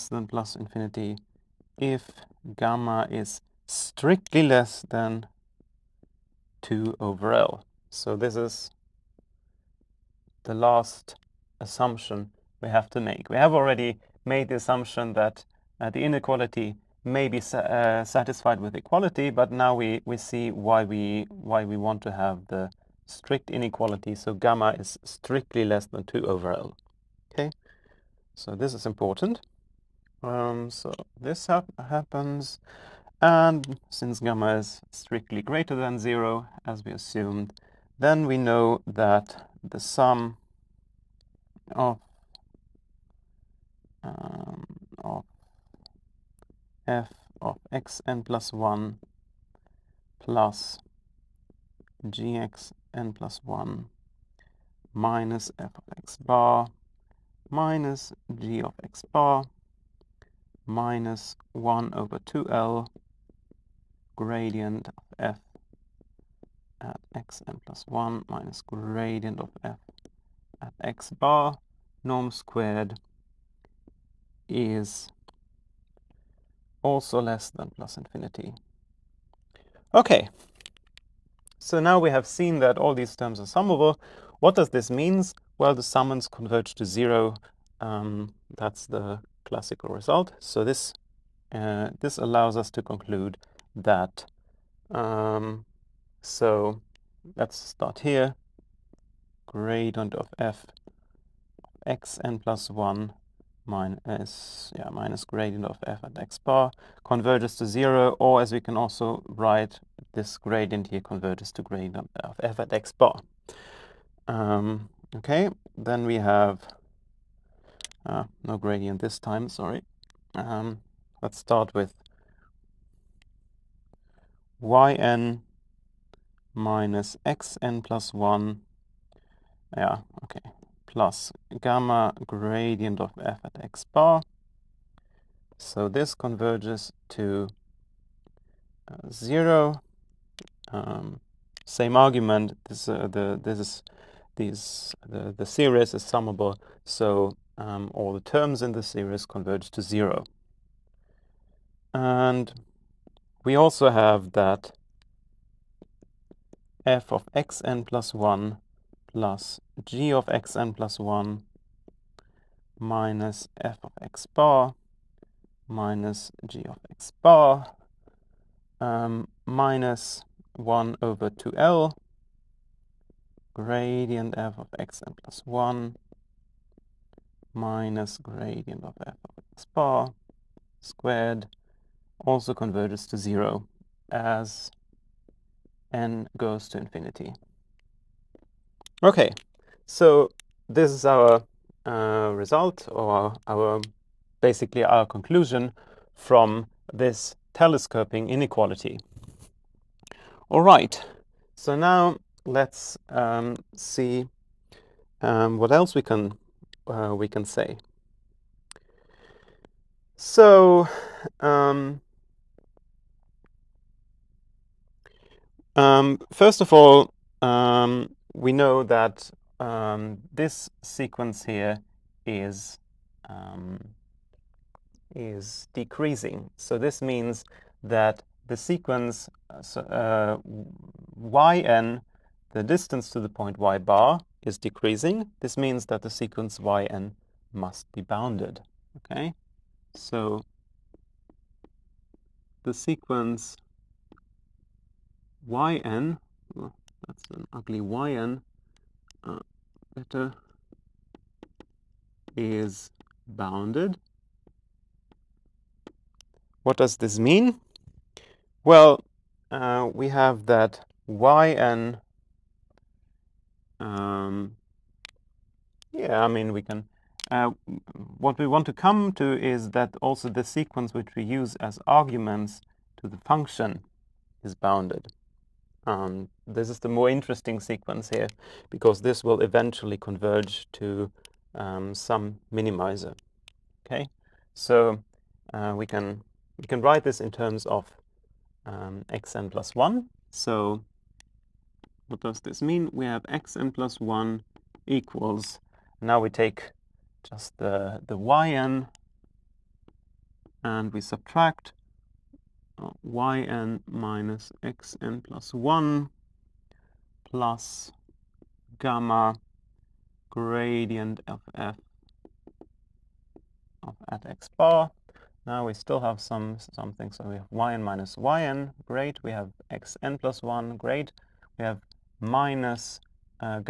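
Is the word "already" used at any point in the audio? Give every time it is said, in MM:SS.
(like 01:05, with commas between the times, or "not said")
00:13.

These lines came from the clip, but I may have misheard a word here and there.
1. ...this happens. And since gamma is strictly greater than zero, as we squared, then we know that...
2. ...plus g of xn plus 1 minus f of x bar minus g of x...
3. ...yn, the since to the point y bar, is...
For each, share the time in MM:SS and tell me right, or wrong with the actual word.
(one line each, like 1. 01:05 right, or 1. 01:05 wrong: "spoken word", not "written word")
1. 00:31 wrong: "assumed", not "squared"
2. 02:39 right
3. 03:51 wrong: "distance", not "since".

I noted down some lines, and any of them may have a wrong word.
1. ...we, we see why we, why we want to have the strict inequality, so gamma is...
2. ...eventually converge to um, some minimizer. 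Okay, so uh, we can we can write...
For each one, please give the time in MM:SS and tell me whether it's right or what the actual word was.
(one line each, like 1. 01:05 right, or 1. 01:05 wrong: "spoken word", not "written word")
1. 00:19 right
2. 04:39 right.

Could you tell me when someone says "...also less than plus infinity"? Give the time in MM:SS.
01:16.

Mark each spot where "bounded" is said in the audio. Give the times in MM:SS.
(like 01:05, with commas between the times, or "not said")
03:58, 04:13, 04:34.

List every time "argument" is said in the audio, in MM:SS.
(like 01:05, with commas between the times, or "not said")
02:21, 04:31.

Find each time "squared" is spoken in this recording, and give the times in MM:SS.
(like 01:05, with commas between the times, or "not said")
01:12, 03:00.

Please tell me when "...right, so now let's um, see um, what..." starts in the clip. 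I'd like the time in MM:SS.
03:20.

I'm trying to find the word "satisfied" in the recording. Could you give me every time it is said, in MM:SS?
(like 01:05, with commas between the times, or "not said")
00:18.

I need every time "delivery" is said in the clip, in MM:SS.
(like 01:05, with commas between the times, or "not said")
not said.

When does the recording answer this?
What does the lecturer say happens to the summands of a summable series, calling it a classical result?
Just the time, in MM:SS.
01:26.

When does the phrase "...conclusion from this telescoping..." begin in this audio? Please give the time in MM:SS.
03:15.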